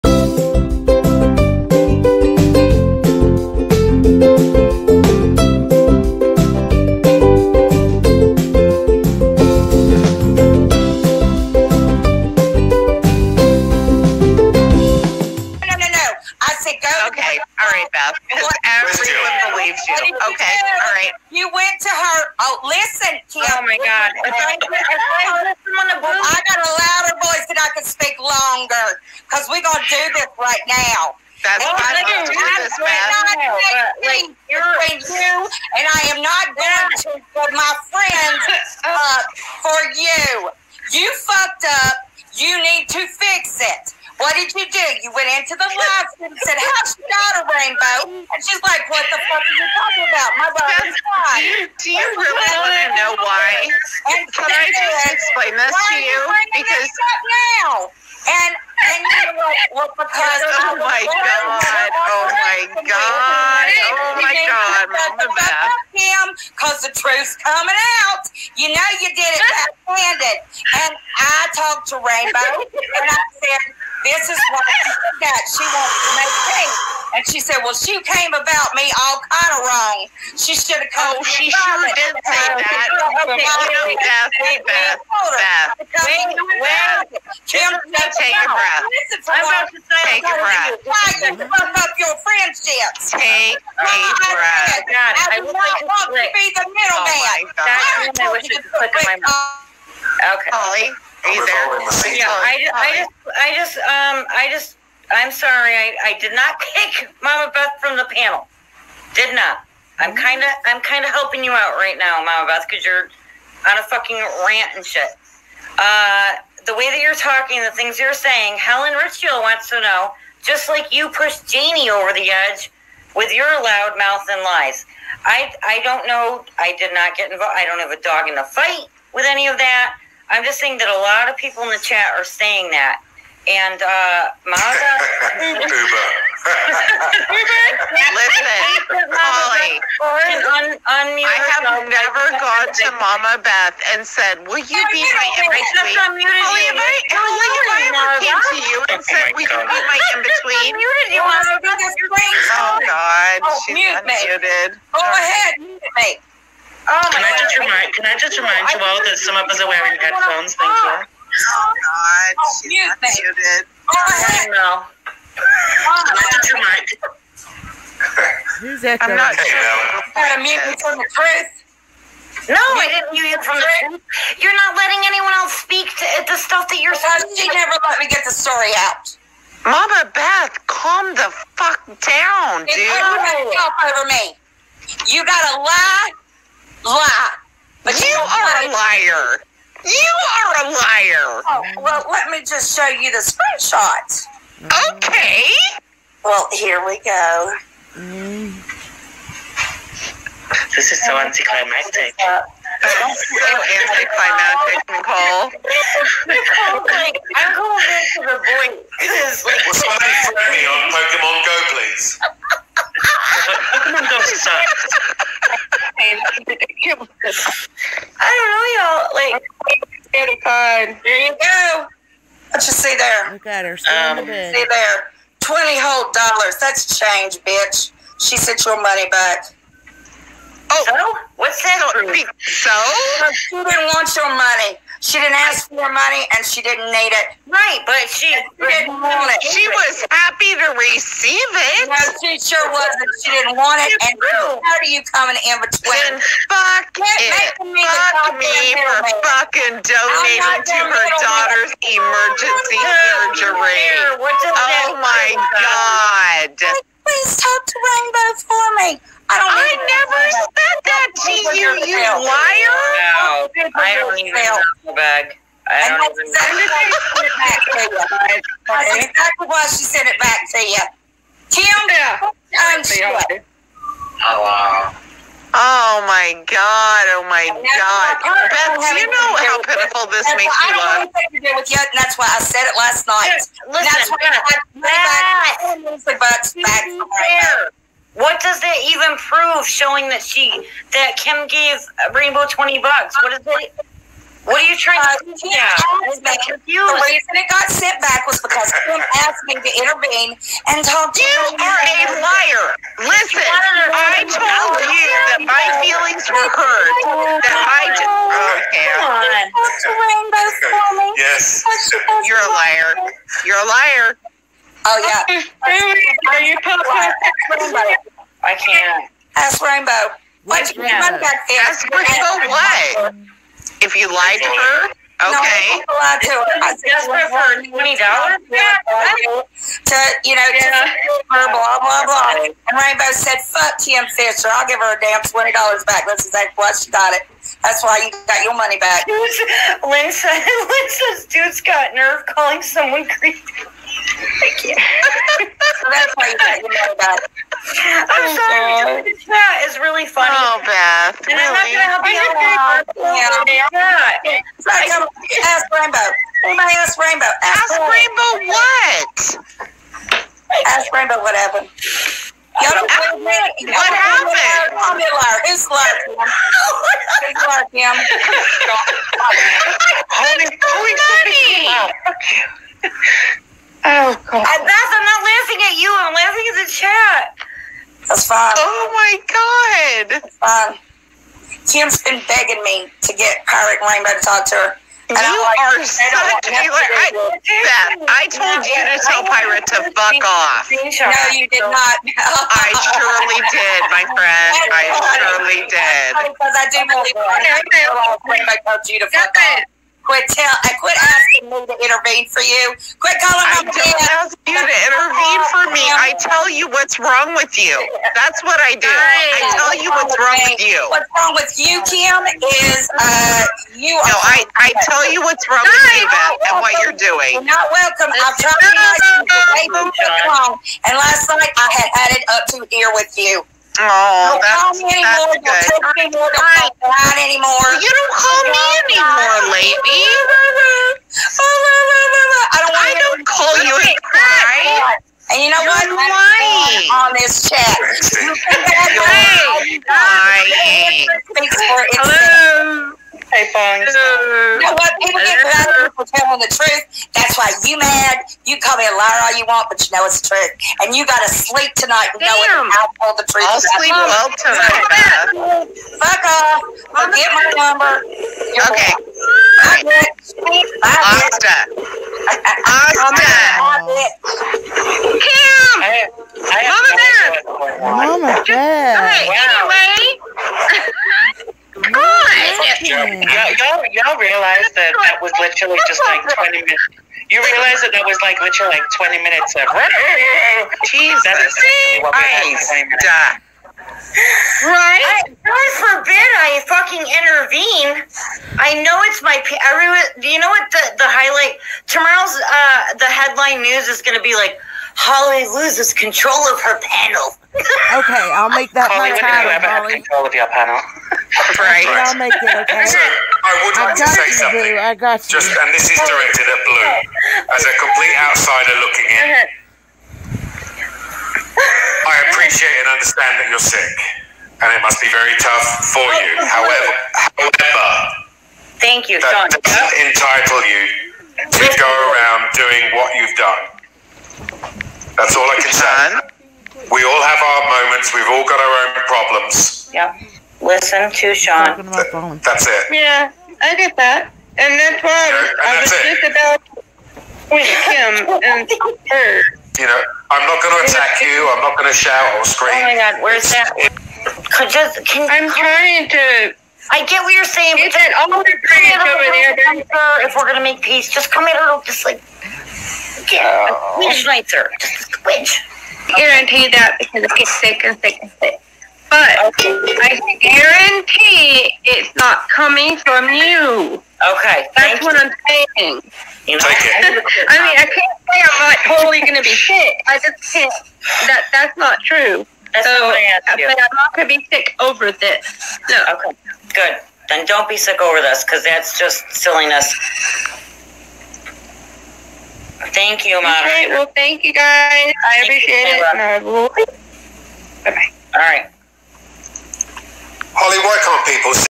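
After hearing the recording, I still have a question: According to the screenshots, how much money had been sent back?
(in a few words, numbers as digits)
$20.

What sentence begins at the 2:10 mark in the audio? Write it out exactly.
I'm just saying that a lot of people in the chat are saying that.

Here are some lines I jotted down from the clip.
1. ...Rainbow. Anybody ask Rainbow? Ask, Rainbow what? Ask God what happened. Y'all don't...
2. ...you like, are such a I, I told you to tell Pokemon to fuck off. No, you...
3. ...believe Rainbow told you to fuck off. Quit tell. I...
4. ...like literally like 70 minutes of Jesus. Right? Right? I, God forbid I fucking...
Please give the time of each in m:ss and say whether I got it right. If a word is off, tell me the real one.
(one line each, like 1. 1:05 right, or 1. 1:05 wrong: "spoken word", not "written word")
1. 5:55 wrong: "Rainbow", not "God"
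2. 6:25 wrong: "Pirate", not "Pokemon"
3. 6:36 right
4. 7:58 wrong: "20", not "70".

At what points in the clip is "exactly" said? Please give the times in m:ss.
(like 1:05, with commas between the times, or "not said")
4:29, 5:36.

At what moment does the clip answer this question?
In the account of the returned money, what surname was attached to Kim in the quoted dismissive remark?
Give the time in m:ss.
5:33.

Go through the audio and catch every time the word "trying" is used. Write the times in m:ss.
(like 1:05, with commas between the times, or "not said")
4:54, 9:05.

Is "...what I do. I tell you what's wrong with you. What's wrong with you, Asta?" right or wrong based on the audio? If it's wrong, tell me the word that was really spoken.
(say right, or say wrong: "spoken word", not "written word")
wrong: "Kim", not "Asta".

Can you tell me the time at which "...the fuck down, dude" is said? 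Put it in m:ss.
3:01.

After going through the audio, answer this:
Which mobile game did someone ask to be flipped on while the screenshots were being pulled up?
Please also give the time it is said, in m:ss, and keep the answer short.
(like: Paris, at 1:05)
Pokemon Go, at 3:30.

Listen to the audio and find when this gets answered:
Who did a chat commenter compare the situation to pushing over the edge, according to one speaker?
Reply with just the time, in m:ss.
2:01.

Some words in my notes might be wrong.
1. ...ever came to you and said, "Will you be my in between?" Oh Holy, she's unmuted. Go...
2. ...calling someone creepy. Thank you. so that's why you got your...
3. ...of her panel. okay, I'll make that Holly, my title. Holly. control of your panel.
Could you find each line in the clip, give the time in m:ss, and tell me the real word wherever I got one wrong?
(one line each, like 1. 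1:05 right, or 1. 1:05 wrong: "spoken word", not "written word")
1. 2:27 wrong: "God", not "Holy"
2. 5:42 right
3. 8:16 right.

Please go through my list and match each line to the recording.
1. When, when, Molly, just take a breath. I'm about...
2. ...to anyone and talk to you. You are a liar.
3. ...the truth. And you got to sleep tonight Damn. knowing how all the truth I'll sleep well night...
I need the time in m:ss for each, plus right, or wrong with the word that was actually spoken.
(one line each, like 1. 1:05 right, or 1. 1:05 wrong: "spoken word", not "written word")
1. 1:26 wrong: "Kim", not "Molly"
2. 4:59 wrong: "intervene", not "anyone"
3. 7:30 wrong: "tonight", not "night".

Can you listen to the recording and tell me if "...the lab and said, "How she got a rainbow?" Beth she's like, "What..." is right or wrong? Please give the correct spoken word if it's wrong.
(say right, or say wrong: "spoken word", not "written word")
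wrong: "And", not "Beth".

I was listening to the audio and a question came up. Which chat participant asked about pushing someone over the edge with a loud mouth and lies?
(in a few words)
Helen Richfield.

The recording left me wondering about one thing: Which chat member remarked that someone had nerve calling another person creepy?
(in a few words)
Lynn.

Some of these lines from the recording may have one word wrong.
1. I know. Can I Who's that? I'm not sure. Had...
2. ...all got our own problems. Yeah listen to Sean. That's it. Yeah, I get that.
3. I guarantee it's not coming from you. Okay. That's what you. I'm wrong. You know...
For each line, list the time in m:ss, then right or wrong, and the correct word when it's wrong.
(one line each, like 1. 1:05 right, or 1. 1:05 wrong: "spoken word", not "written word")
1. 2:43 right
2. 8:48 right
3. 9:19 wrong: "saying", not "wrong".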